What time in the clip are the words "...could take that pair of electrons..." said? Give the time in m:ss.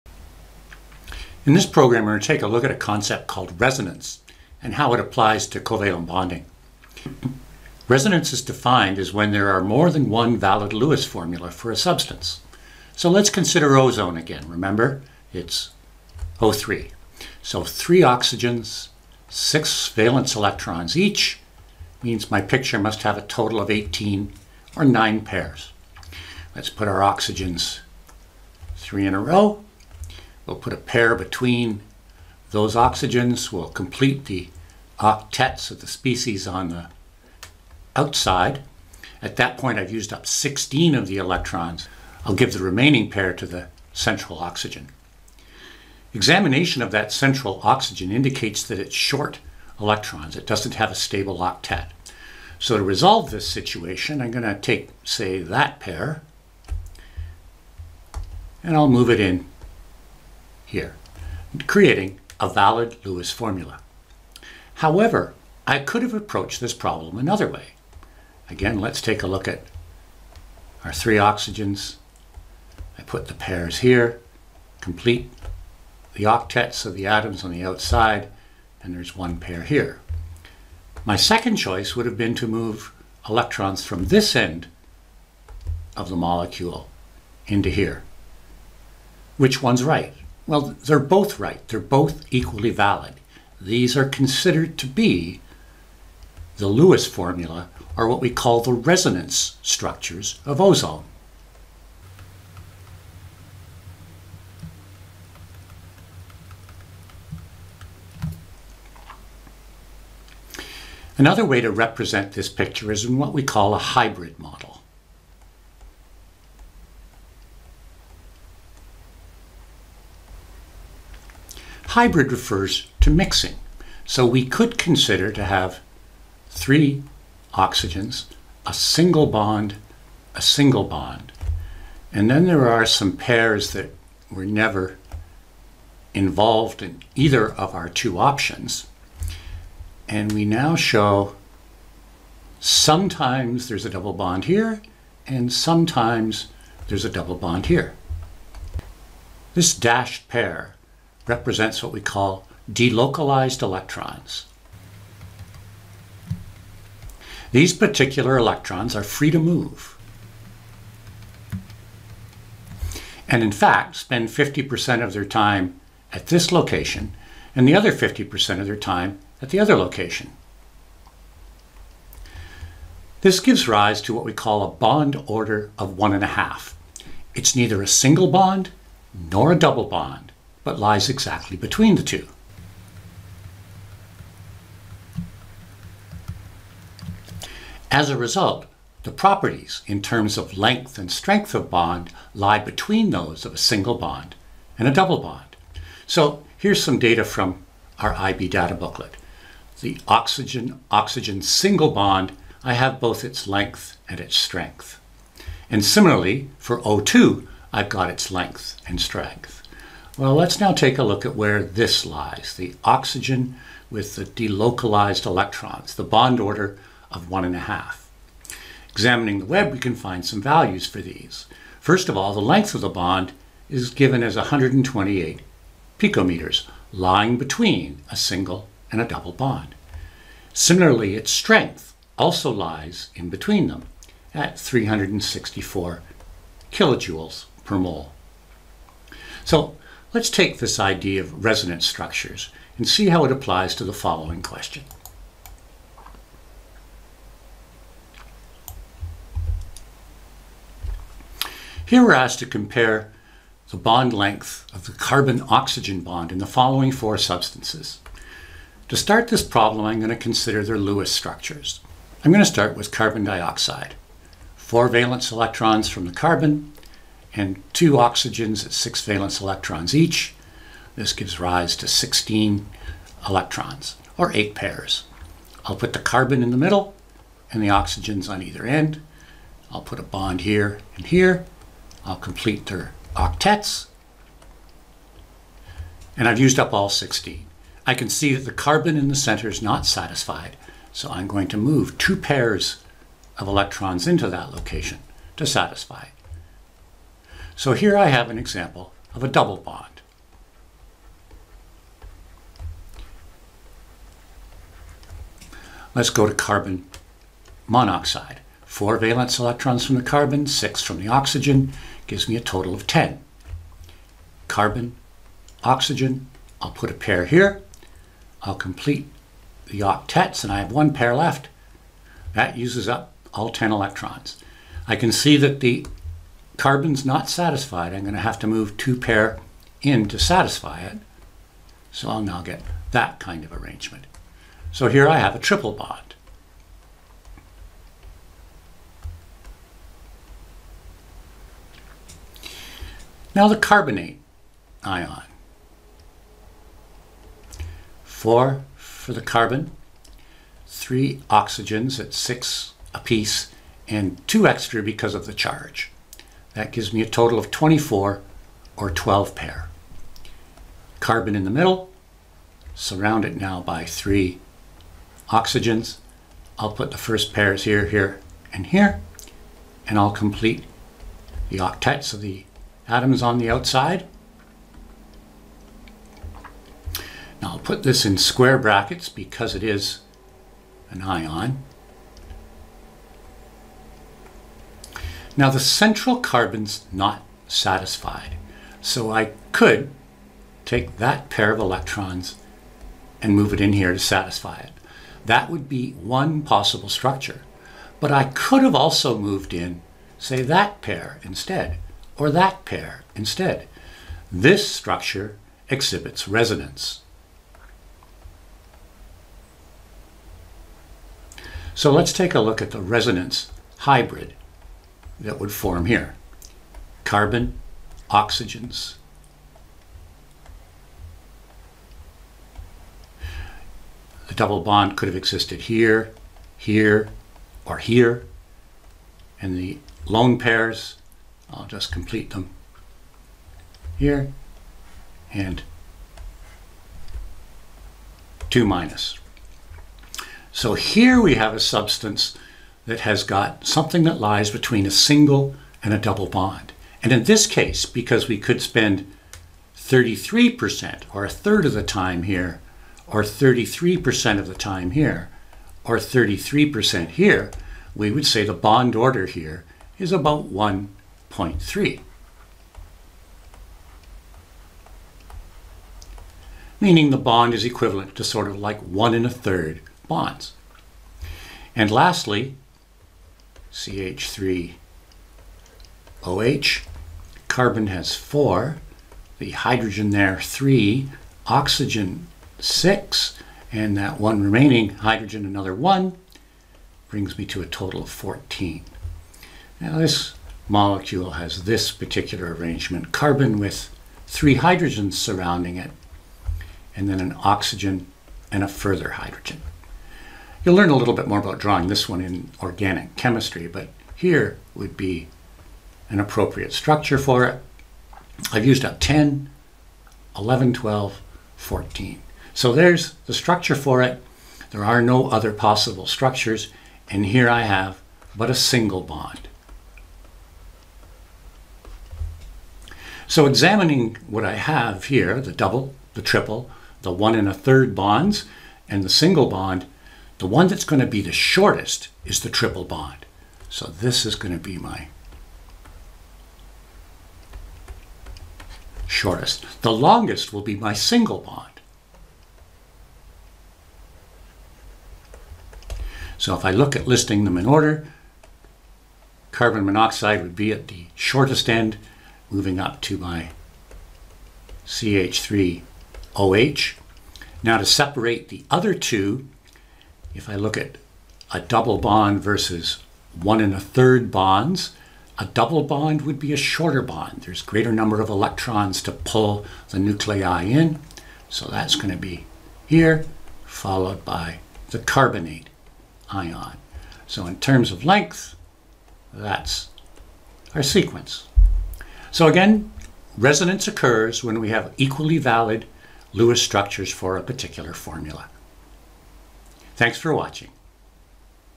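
6:29.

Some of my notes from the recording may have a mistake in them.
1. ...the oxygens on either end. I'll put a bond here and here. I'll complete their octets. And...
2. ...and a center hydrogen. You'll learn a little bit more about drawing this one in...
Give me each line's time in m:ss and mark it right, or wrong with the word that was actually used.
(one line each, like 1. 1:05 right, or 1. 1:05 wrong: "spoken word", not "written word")
1. 4:37 right
2. 8:18 wrong: "further", not "center".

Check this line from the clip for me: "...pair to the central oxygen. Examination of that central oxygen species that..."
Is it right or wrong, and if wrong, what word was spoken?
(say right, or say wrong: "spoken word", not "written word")
wrong: "indicates", not "species".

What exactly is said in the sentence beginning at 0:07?
Resonance is defined as when there are more than one valid Lewis formula for a substance.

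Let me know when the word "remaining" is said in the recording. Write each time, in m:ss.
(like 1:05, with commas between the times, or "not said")
0:42, 8:04.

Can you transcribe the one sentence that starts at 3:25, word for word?
And similarly, for O2, I've got its length and strength.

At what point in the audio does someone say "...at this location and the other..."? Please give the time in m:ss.
2:46.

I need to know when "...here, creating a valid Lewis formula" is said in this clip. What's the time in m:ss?
1:00.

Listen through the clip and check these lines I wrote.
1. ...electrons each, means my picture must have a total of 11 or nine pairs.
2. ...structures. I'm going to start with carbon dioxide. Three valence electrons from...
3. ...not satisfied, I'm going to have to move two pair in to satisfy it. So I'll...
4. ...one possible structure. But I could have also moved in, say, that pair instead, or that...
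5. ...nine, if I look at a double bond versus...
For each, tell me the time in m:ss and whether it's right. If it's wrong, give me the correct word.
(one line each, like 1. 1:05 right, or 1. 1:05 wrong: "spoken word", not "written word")
1. 0:20 wrong: "18", not "11"
2. 4:21 wrong: "Four", not "Three"
3. 5:27 right
4. 6:35 right
5. 9:18 wrong: "two", not "nine".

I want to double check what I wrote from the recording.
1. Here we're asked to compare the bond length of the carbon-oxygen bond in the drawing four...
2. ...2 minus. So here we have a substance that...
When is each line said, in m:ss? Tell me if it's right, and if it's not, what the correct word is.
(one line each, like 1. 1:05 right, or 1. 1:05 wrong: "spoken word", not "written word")
1. 4:11 wrong: "following", not "drawing"
2. 7:18 right.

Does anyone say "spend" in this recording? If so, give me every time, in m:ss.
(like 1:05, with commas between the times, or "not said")
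2:43, 7:28.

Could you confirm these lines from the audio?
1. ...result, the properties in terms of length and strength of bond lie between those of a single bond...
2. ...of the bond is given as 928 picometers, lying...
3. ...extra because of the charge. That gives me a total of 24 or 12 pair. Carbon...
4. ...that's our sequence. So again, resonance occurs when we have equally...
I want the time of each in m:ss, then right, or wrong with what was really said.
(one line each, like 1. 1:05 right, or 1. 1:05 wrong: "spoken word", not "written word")
1. 3:08 right
2. 3:42 wrong: "128", not "928"
3. 5:54 right
4. 9:39 right.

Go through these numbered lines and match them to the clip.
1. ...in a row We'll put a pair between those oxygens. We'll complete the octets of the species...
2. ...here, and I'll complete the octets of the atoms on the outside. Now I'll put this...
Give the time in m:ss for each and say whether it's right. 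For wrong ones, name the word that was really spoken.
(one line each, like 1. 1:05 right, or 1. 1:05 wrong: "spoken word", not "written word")
1. 0:29 right
2. 6:08 right.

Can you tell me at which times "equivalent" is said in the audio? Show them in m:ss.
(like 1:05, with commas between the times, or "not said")
7:47.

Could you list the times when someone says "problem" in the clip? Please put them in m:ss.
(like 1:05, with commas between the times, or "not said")
1:06, 4:19.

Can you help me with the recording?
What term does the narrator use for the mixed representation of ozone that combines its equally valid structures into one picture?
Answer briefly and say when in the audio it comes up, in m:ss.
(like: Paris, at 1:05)
hybrid model, at 1:53.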